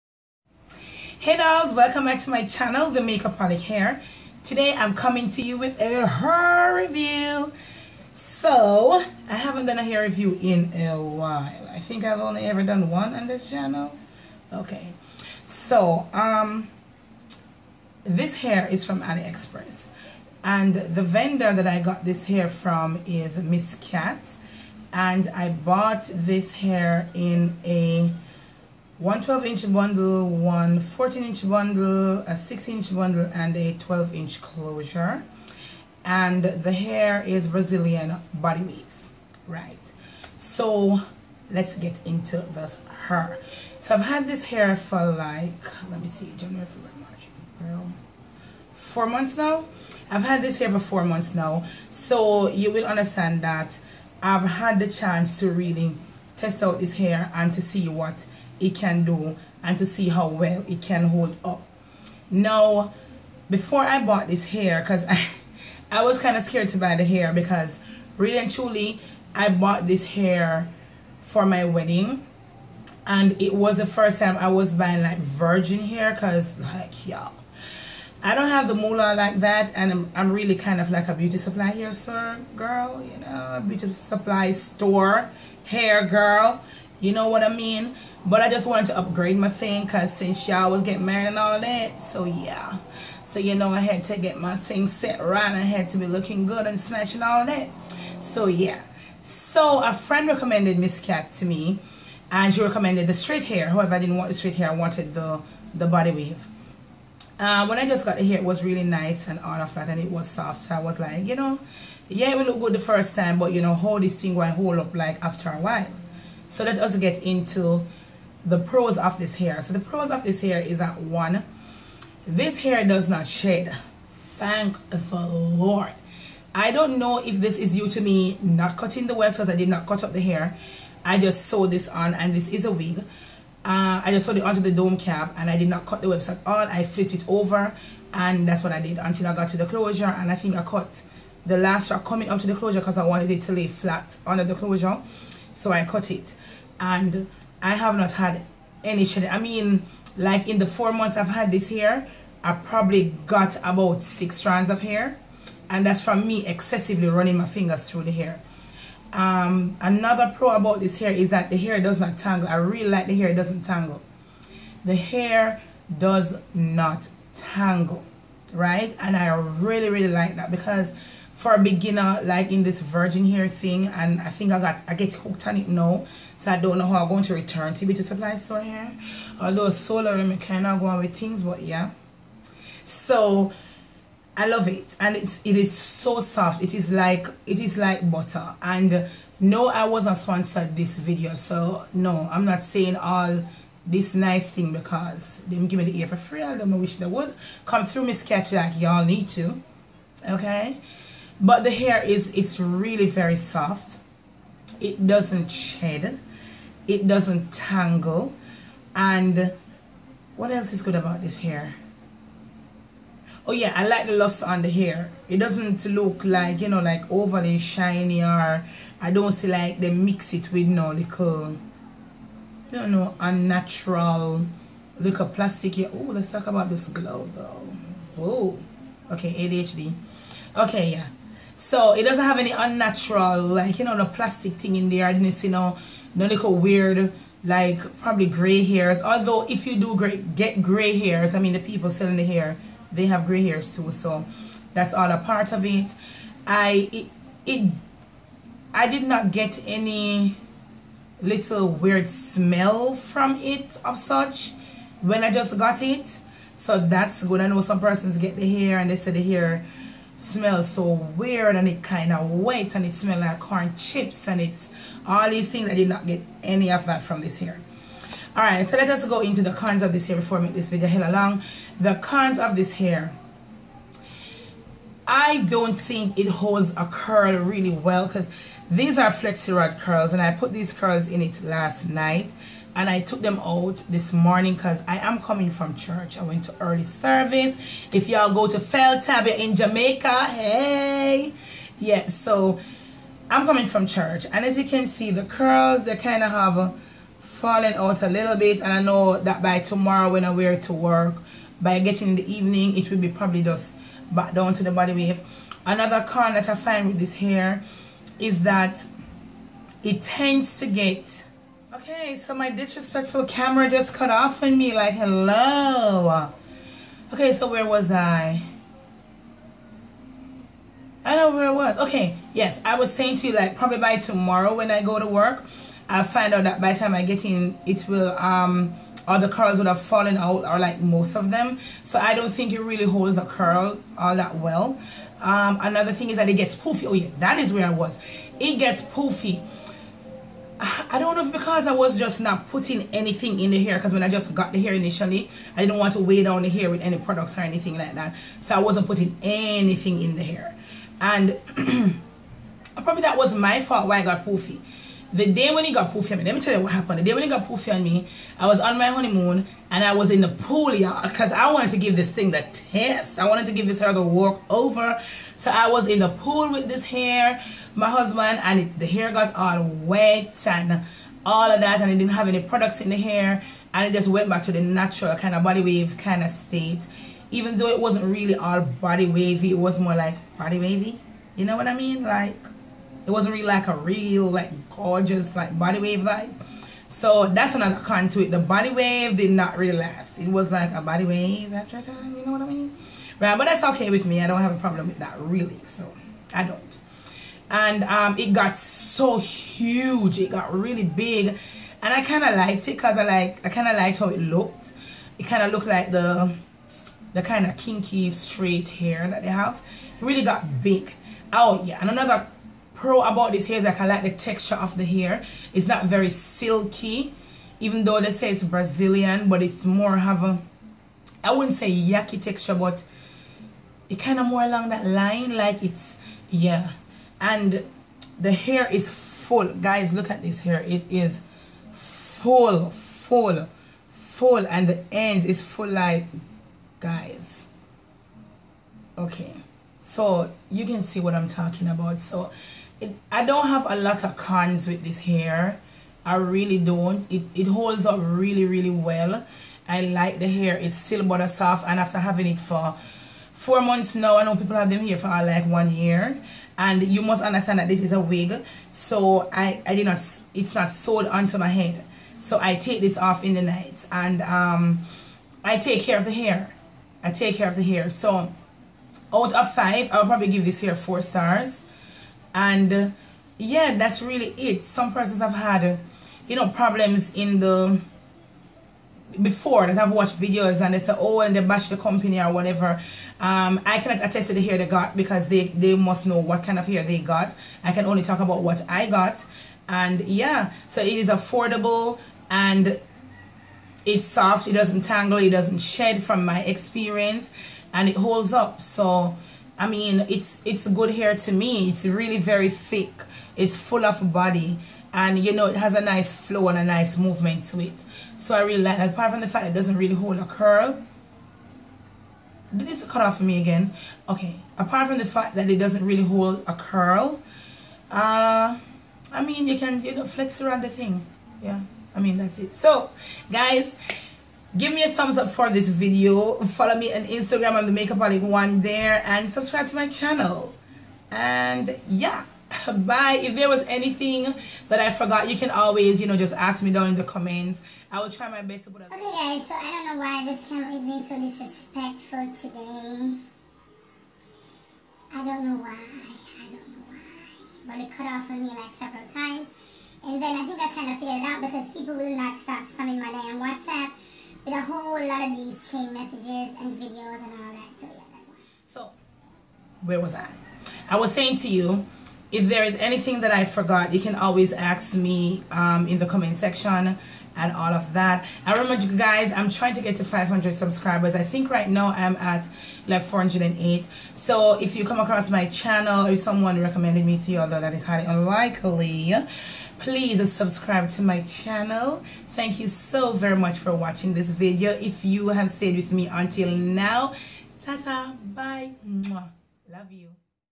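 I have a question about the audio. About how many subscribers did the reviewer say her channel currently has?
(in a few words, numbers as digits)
408.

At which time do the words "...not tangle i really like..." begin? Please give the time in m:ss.
2:41.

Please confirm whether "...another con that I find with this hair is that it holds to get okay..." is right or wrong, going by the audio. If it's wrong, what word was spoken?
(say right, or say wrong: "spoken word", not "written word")
wrong: "tends", not "holds".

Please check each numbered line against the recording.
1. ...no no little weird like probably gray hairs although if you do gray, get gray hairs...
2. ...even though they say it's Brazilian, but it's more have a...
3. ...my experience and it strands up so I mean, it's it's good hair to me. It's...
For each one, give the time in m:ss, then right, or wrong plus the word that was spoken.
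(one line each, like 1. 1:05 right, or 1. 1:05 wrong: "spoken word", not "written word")
1. 3:55 right
2. 6:57 right
3. 8:16 wrong: "holds", not "strands".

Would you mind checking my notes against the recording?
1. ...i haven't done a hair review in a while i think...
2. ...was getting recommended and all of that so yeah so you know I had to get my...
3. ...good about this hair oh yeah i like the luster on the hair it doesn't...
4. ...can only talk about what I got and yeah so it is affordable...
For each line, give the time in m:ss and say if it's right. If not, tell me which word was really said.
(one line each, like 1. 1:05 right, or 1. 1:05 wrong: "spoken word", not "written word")
1. 0:09 right
2. 1:30 wrong: "married", not "recommended"
3. 3:30 right
4. 8:07 right.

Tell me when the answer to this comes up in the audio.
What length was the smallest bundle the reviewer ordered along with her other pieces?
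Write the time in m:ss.
0:32.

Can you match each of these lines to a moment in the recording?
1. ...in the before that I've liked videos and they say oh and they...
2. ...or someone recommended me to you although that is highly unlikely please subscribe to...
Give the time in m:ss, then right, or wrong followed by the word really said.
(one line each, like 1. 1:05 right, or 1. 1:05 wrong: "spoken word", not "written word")
1. 7:57 wrong: "watched", not "liked"
2. 9:36 right.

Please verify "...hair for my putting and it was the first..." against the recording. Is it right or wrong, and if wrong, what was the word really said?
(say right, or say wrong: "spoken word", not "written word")
wrong: "wedding", not "putting".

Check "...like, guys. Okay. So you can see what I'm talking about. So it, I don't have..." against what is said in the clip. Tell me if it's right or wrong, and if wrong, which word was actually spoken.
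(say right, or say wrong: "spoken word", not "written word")
right.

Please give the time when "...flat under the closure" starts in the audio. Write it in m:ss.
2:23.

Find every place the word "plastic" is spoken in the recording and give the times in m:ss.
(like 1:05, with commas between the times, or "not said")
3:45, 3:54.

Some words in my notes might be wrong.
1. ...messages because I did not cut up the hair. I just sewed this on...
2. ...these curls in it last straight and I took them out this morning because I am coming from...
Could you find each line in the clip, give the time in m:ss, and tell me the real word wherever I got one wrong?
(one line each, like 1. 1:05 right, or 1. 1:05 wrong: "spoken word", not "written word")
1. 2:09 wrong: "waves", not "messages"
2. 4:40 wrong: "night", not "straight".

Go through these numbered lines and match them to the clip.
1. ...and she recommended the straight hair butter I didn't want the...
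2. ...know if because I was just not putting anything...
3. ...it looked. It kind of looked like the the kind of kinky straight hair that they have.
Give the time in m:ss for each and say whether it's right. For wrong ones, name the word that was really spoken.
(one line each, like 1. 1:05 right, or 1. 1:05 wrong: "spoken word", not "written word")
1. 1:42 wrong: "however", not "butter"
2. 5:41 right
3. 6:44 right.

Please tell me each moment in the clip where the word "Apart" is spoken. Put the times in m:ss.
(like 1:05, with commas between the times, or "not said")
8:28, 8:34.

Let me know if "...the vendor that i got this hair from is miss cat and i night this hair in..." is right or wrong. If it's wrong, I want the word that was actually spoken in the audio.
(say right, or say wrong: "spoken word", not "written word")
wrong: "bought", not "night".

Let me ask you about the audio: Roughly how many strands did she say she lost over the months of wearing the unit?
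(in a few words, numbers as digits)
6.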